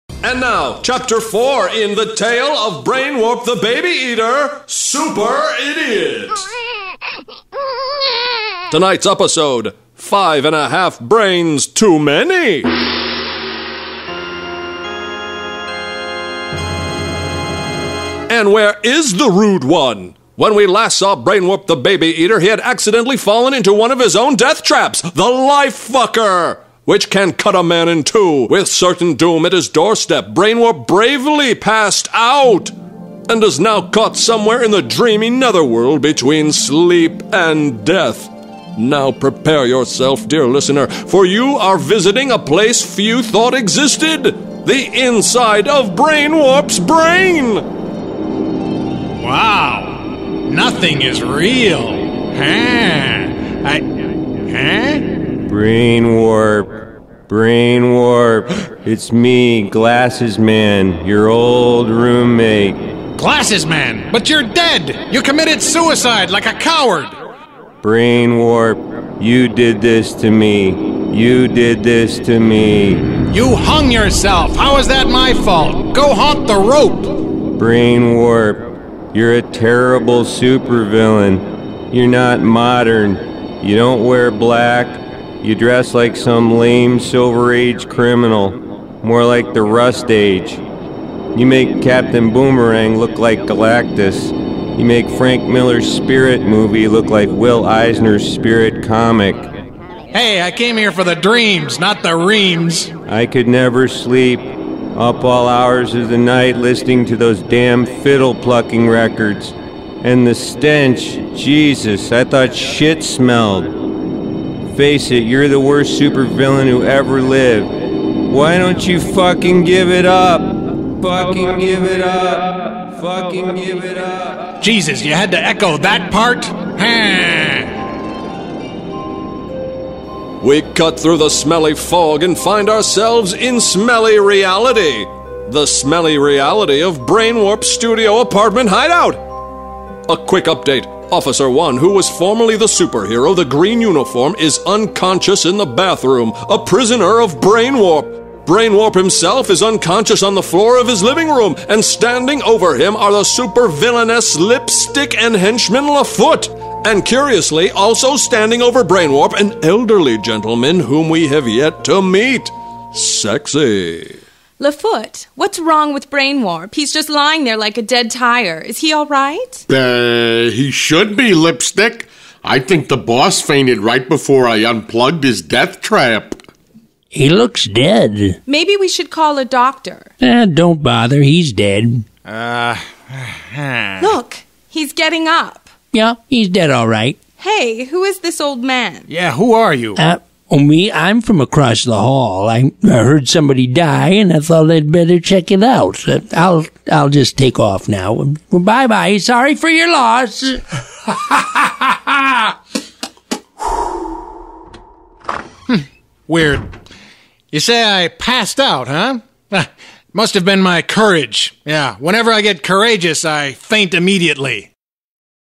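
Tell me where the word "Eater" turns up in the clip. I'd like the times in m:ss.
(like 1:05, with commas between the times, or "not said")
0:03, 0:22.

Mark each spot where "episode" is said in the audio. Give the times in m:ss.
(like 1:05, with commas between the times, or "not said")
0:09.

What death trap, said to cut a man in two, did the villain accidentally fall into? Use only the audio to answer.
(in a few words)
Life Fucker.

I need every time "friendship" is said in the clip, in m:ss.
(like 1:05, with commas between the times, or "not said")
not said.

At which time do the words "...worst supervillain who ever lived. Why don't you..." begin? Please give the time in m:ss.
1:55.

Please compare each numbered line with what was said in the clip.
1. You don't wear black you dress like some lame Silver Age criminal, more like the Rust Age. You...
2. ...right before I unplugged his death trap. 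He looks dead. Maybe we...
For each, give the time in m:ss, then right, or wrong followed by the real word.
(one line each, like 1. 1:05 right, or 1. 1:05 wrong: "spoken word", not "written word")
1. 1:23 right
2. 2:53 right.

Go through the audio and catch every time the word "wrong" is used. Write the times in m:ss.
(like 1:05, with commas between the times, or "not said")
2:45.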